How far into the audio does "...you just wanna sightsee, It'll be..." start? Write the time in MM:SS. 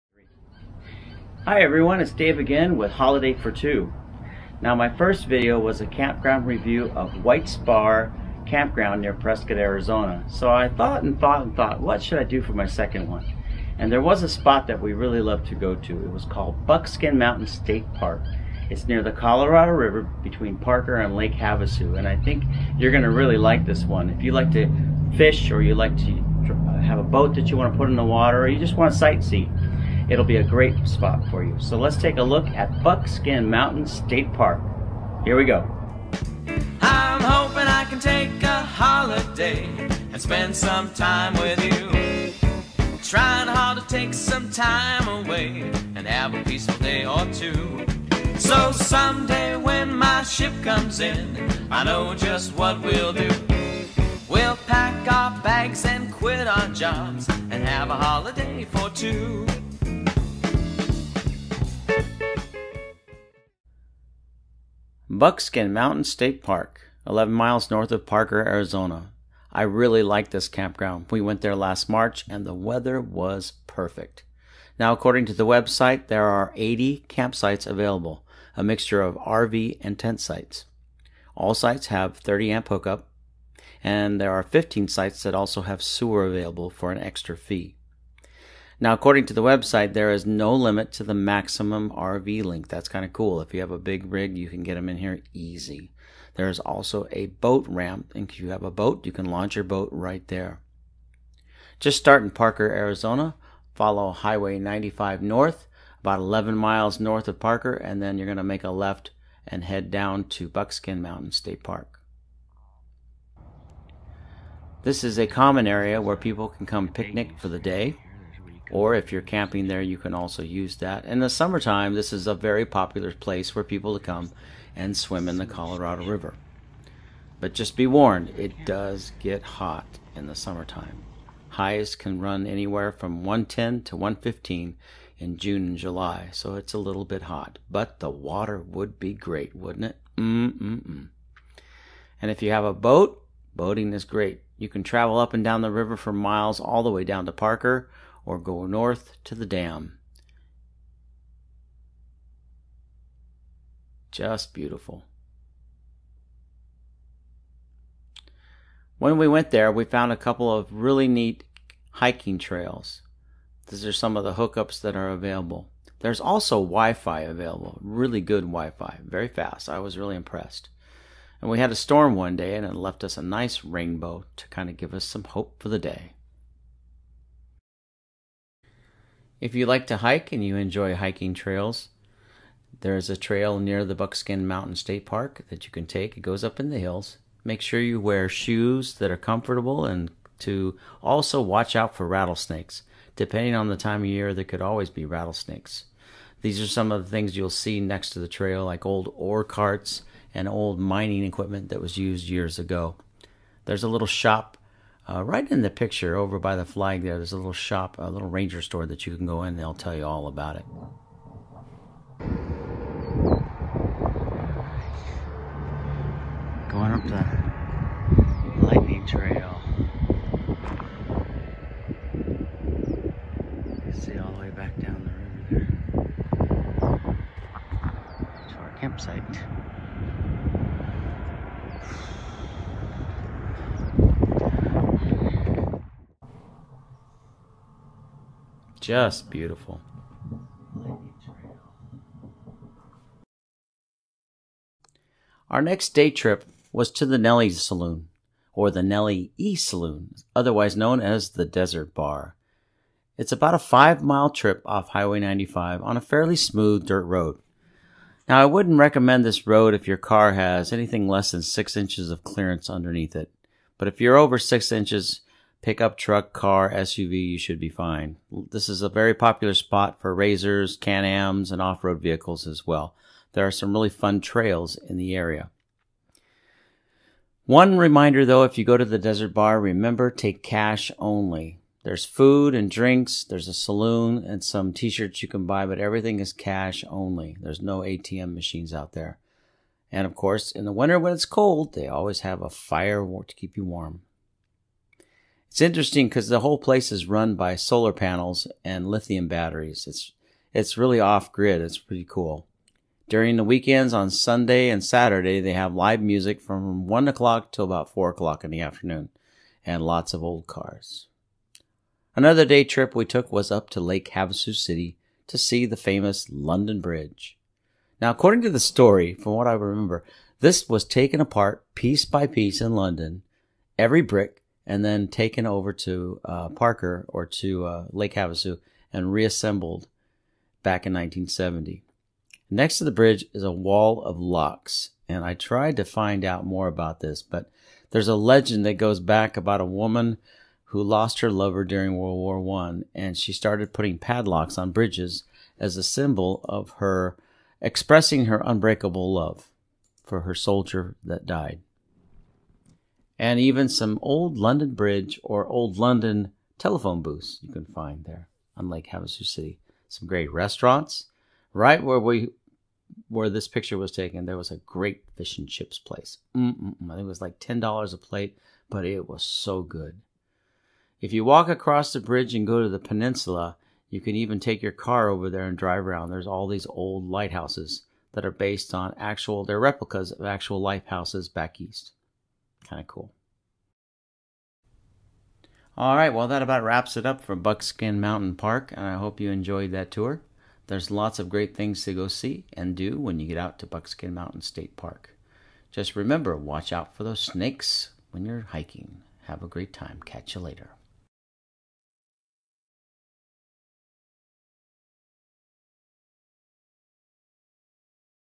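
00:28.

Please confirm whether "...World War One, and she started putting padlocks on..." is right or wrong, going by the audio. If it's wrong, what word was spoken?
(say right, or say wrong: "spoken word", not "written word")
right.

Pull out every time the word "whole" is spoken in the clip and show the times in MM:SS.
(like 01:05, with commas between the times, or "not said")
04:56.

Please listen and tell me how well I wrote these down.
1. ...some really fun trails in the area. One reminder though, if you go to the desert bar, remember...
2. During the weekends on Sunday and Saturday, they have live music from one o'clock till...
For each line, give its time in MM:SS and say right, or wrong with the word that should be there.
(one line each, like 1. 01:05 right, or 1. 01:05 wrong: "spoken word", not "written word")
1. 04:33 right
2. 05:03 right.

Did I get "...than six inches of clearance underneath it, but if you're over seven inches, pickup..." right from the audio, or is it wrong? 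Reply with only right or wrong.
wrong.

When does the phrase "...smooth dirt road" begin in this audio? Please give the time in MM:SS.
04:16.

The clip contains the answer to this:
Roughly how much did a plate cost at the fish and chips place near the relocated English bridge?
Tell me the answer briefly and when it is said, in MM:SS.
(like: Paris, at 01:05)
$10, at 06:07.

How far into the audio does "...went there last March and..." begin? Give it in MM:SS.
01:11.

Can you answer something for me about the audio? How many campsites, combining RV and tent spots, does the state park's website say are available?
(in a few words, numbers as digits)
80.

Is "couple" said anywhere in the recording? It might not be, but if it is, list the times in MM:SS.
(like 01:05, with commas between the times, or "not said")
02:40.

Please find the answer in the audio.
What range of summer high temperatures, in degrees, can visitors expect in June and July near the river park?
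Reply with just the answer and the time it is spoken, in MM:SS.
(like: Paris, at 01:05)
110 to 115, at 02:13.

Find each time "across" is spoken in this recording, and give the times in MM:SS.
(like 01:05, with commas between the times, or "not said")
06:11.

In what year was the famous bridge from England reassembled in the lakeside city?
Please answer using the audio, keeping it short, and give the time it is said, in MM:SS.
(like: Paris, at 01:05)
1970, at 05:30.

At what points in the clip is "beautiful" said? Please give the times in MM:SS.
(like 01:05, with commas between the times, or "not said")
02:34, 03:59.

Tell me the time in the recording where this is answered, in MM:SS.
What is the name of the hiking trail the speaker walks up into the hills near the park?
03:38.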